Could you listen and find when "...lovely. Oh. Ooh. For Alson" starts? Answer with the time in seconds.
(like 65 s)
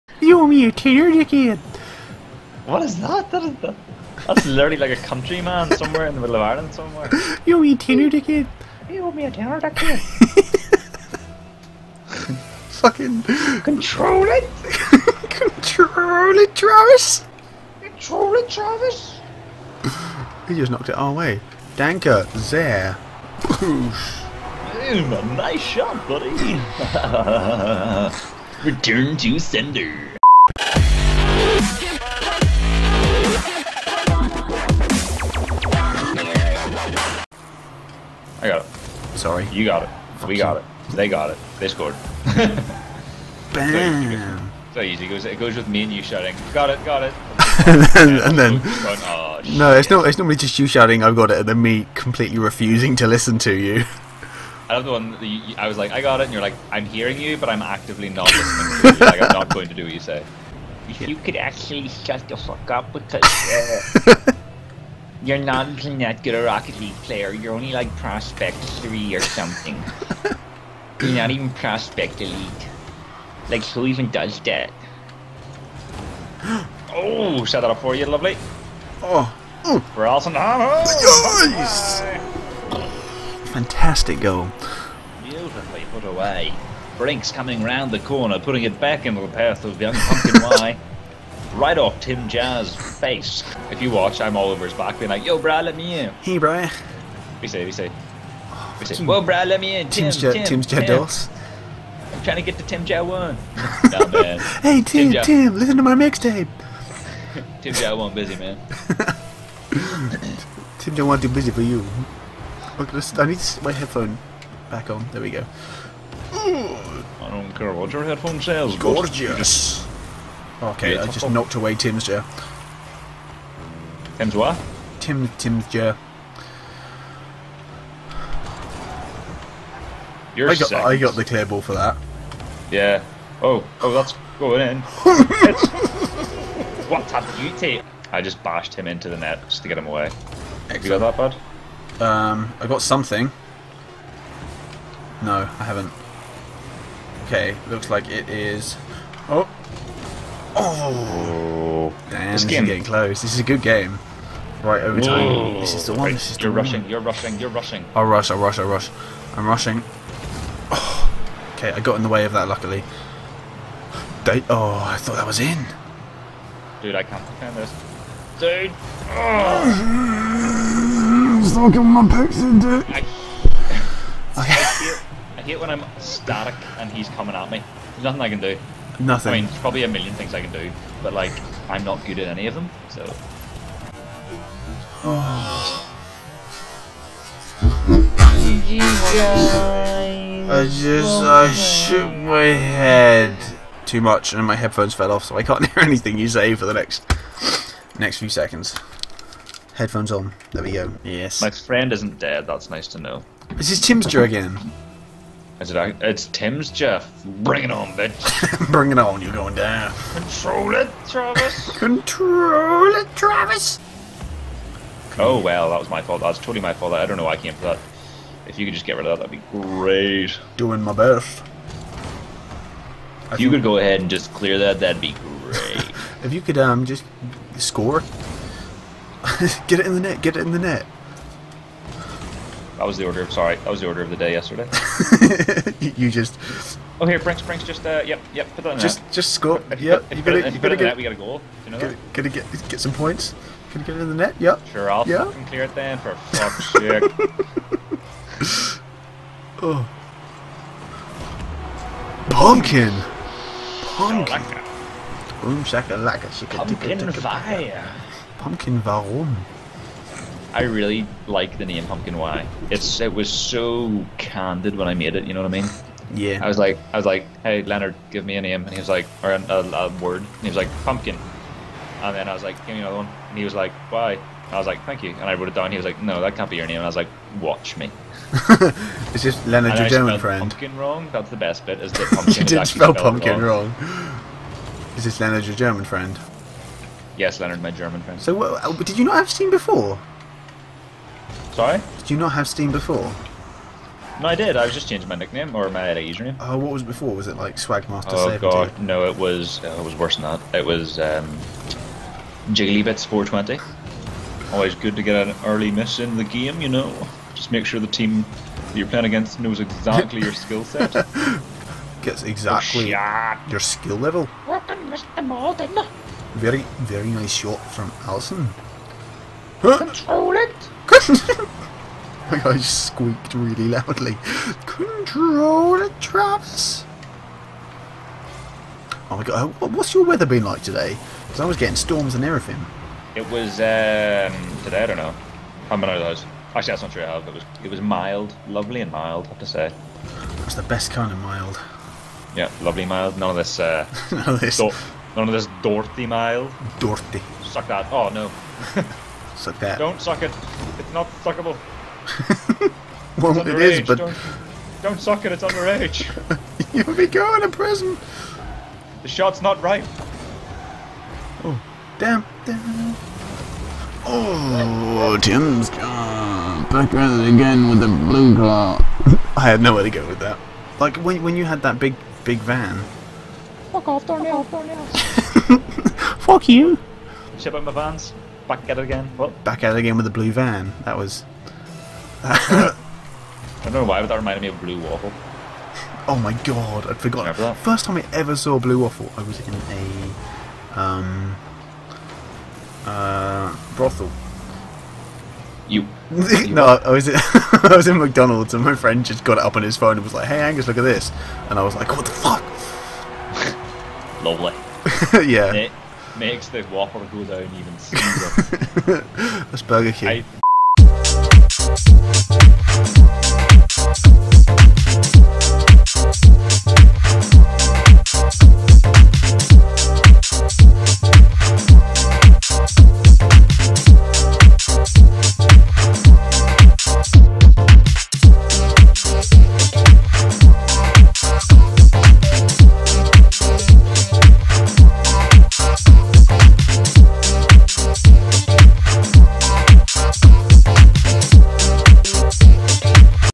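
78 s.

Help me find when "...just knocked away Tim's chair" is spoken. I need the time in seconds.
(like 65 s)
121 s.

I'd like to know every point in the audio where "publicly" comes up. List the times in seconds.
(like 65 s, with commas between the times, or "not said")
not said.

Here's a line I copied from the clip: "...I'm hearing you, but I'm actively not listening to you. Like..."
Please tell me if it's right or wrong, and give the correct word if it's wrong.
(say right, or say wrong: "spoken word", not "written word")
right.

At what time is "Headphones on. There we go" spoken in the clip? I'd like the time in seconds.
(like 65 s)
199 s.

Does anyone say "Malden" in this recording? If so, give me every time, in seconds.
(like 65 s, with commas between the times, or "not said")
315 s.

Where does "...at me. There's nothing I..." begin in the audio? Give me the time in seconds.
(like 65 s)
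177 s.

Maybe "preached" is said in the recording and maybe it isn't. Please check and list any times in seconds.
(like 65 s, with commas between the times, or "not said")
not said.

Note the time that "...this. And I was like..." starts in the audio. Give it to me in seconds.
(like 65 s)
400 s.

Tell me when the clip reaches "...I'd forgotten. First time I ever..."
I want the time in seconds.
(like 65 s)
386 s.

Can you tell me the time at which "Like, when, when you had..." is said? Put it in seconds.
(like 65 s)
370 s.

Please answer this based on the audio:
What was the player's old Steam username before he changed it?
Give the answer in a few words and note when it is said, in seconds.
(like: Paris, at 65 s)
Jigglybits420, at 302 s.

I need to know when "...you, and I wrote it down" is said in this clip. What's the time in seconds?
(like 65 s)
275 s.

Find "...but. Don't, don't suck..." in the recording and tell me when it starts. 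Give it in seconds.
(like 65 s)
353 s.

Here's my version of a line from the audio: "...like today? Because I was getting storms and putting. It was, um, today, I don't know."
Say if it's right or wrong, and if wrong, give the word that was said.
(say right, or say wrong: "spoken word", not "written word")
wrong: "everything", not "putting".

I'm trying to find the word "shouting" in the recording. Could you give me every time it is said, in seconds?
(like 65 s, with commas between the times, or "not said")
46 s, 50 s.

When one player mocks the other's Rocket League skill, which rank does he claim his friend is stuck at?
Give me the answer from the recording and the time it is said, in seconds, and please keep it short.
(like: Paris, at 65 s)
Prospect 3, at 67 s.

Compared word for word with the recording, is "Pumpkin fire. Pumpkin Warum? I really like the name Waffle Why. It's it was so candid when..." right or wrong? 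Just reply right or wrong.
wrong.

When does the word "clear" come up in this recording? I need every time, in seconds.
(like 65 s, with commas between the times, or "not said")
131 s, 224 s, 245 s.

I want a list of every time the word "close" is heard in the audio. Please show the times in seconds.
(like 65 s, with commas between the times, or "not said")
152 s.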